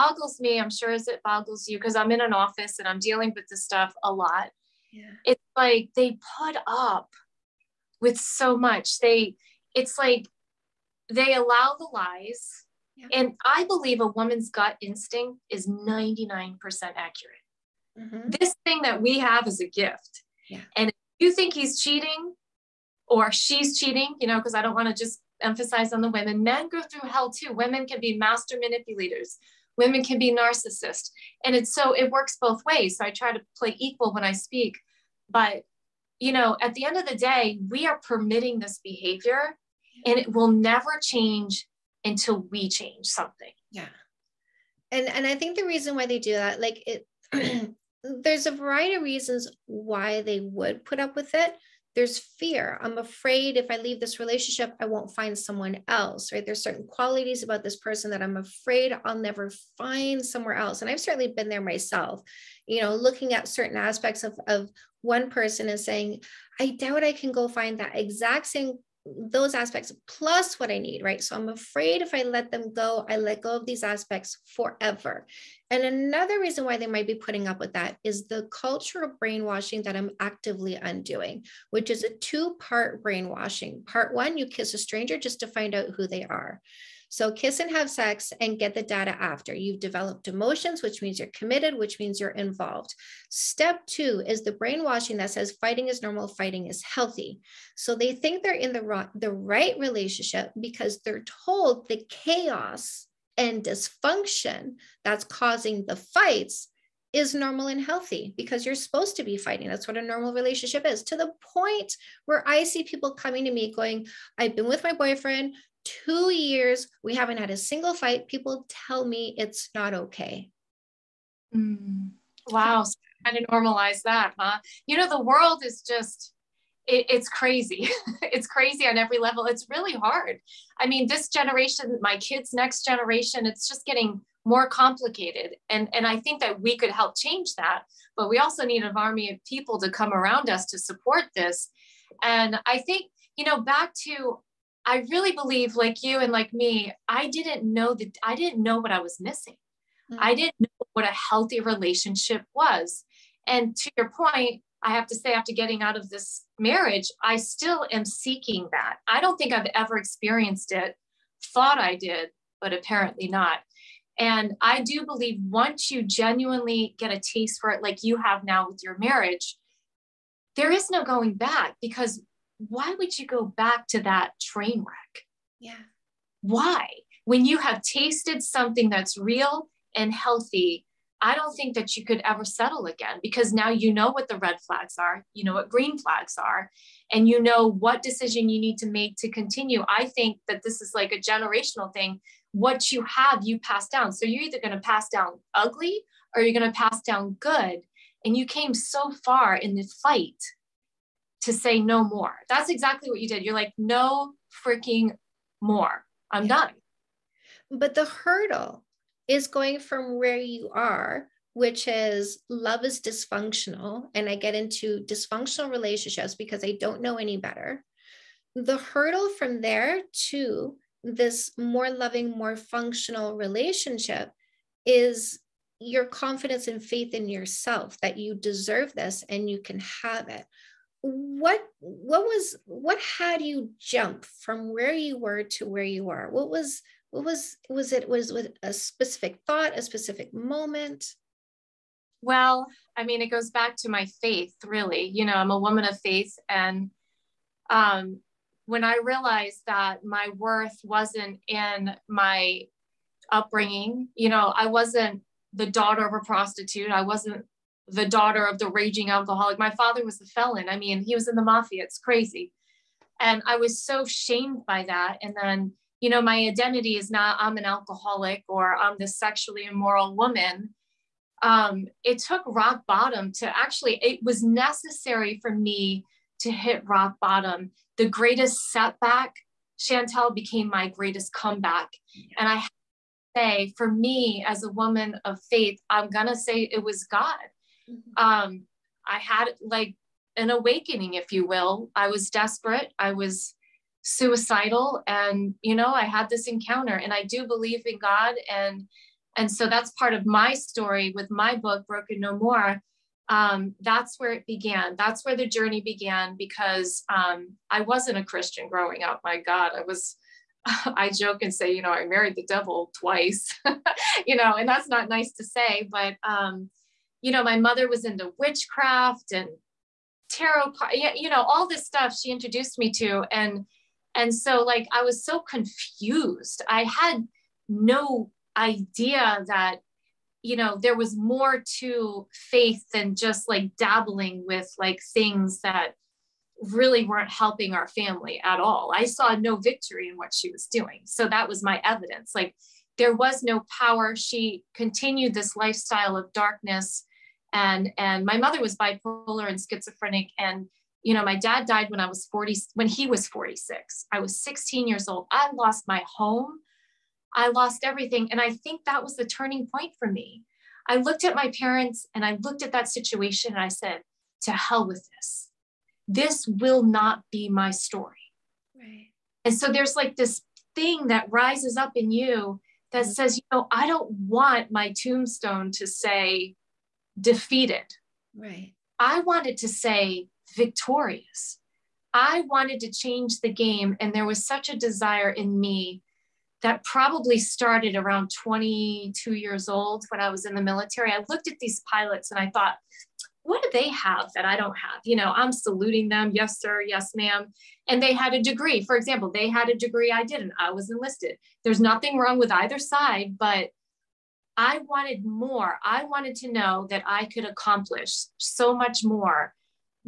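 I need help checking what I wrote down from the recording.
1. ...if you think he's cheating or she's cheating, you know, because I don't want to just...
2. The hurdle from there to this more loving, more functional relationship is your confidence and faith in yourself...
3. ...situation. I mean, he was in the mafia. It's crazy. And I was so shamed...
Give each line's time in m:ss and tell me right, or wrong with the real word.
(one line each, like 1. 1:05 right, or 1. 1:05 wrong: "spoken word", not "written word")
1. 0:20 right
2. 3:38 right
3. 4:20 wrong: "felon", not "situation".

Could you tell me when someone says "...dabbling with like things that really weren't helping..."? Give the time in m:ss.
5:33.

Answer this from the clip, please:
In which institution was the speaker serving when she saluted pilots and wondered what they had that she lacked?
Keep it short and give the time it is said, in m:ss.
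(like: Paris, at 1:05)
the military, at 6:30.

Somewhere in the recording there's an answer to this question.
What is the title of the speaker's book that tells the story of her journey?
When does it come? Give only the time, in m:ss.
5:01.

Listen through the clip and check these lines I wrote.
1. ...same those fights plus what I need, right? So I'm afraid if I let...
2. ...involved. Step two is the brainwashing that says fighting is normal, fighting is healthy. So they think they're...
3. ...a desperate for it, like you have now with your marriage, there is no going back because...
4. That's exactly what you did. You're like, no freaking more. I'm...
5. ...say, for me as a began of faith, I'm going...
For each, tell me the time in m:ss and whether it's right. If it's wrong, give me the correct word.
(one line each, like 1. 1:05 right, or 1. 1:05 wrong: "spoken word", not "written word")
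1. 1:08 wrong: "aspects", not "fights"
2. 1:32 right
3. 2:47 wrong: "taste", not "desperate"
4. 3:22 right
5. 4:43 wrong: "woman", not "began".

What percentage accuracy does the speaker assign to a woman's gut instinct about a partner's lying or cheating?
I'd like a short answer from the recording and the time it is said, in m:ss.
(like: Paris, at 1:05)
99%, at 0:15.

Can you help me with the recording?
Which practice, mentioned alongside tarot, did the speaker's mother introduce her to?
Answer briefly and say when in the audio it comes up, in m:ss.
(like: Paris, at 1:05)
witchcraft, at 5:18.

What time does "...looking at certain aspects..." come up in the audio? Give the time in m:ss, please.
1:02.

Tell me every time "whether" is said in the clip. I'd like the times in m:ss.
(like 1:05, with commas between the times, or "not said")
not said.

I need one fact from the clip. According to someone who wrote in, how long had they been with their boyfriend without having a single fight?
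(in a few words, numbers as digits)
2 years.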